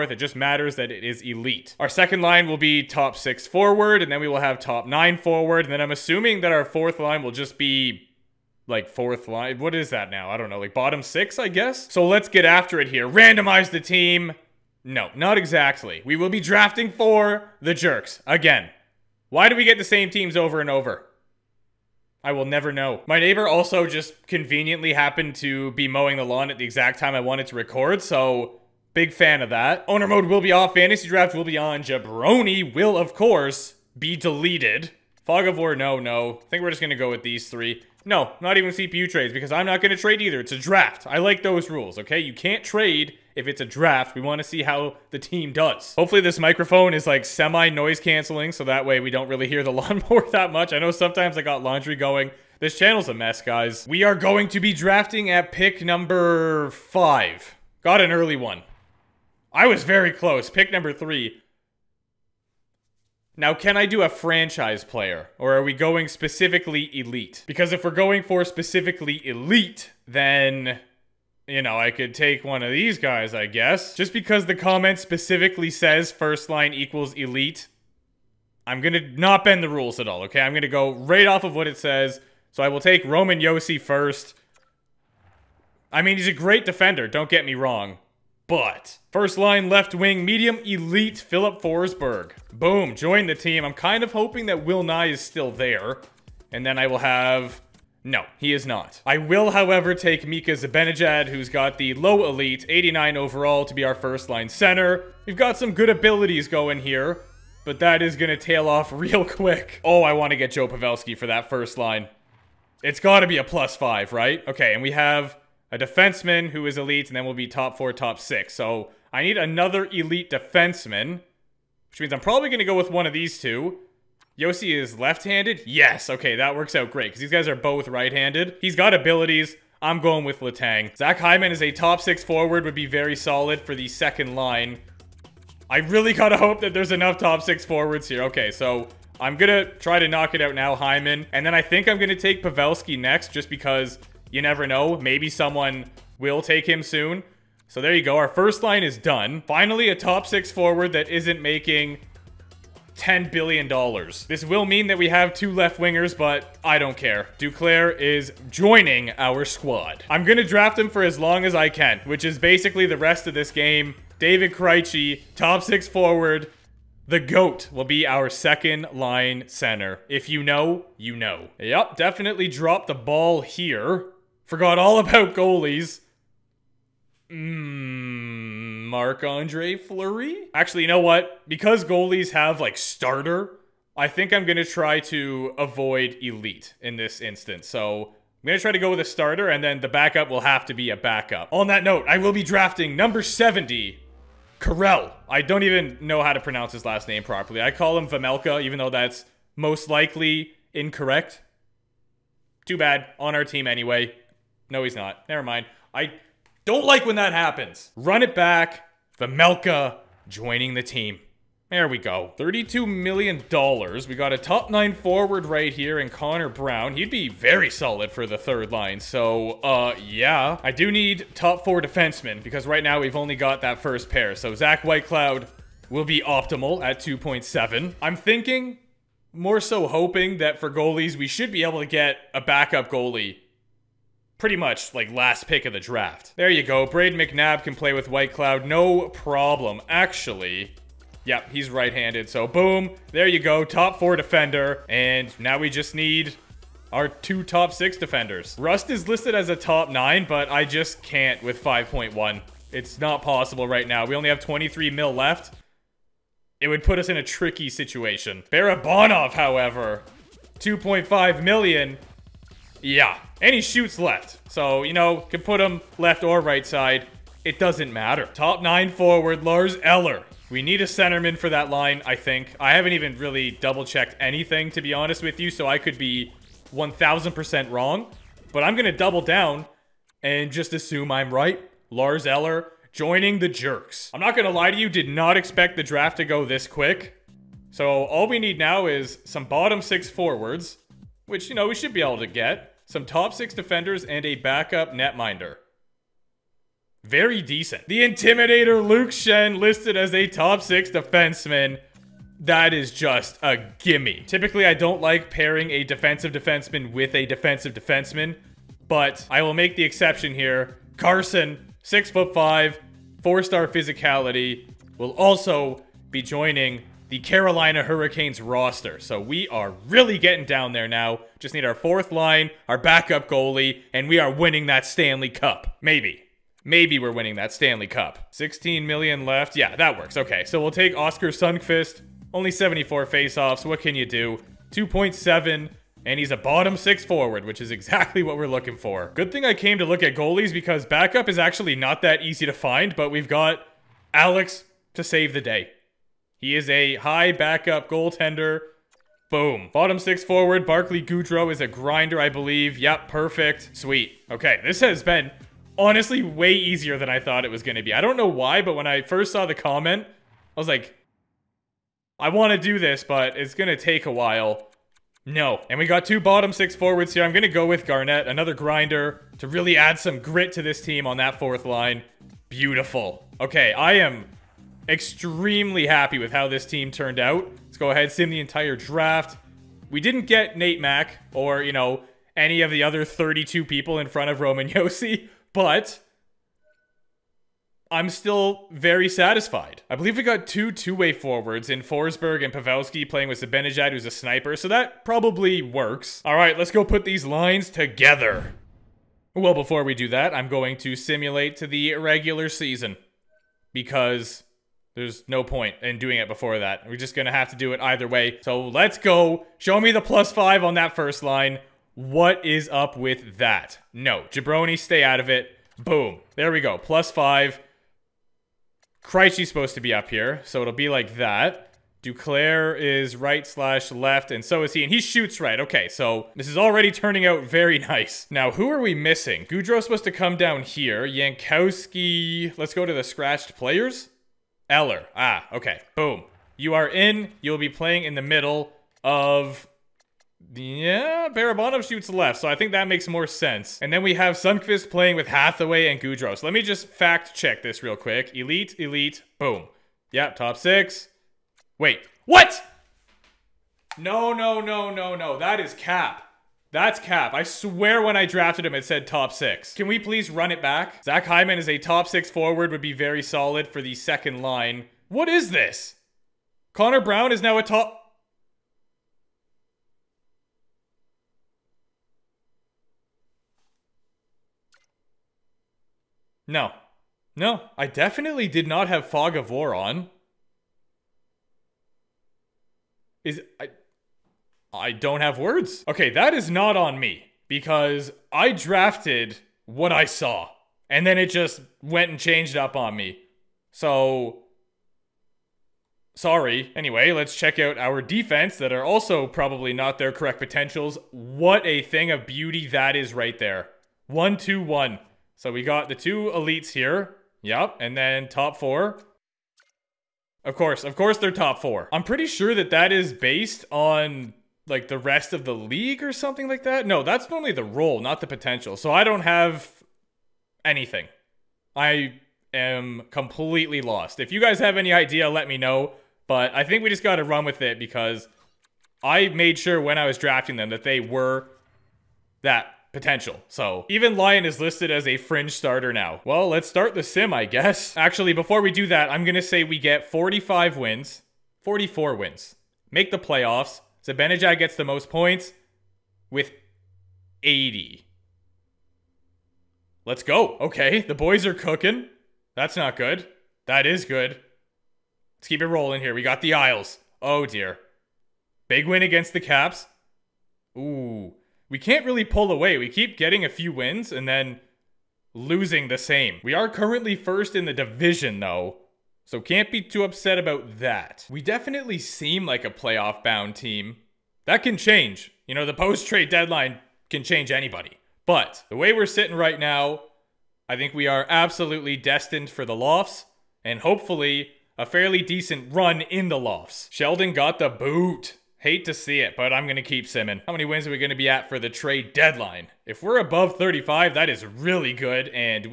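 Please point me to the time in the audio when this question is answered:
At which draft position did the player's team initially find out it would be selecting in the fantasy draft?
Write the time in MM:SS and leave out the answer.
00:55.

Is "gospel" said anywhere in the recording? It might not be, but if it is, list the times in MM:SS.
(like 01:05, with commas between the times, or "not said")
not said.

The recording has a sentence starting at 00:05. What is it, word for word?
And then I'm assuming that our fourth line will just be like fourth line.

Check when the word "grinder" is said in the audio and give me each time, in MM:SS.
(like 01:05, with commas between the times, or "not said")
05:51, 06:08.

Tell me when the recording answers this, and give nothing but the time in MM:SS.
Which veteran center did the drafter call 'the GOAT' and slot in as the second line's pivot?
02:44.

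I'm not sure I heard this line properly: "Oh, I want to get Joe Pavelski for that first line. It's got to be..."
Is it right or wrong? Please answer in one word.
right.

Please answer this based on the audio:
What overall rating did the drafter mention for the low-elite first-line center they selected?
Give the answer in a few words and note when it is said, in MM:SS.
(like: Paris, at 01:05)
89, at 01:42.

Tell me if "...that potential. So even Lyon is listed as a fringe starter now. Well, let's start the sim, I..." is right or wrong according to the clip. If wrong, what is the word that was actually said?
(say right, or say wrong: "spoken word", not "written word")
right.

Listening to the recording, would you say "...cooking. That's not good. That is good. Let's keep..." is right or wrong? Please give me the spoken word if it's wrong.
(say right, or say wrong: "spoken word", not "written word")
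right.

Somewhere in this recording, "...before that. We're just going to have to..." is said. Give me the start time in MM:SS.
06:46.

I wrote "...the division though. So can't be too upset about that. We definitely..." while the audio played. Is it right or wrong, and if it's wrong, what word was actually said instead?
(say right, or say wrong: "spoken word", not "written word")
right.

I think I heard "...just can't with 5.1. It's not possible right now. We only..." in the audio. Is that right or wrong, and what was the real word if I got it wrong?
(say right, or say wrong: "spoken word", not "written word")
right.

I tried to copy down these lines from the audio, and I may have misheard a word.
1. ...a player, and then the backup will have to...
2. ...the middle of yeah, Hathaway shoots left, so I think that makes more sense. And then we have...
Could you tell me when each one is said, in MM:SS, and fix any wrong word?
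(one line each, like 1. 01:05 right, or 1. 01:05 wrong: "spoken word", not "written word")
1. 03:08 wrong: "starter", not "player"
2. 07:18 wrong: "Barabanov", not "Hathaway".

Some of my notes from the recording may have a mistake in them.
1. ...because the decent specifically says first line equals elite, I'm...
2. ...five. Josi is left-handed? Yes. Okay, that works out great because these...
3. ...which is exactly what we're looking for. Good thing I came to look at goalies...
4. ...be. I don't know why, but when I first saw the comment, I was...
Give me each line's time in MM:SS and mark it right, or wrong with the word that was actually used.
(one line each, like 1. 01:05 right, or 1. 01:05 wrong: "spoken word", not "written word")
1. 01:14 wrong: "comment", not "decent"
2. 02:03 wrong: "two", not "five"
3. 05:37 right
4. 05:57 right.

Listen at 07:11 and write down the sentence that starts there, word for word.
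Yankowski, let's go to the scratched players.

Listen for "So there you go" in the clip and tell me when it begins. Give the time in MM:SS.
02:27.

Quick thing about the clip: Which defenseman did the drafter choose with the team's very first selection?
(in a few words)
Roman Josi.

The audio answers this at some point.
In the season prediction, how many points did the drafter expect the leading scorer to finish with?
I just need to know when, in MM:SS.
09:07.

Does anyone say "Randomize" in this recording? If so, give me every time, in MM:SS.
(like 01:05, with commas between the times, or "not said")
00:13.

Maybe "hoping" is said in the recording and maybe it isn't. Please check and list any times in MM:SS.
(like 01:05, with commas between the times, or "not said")
01:34, 03:49.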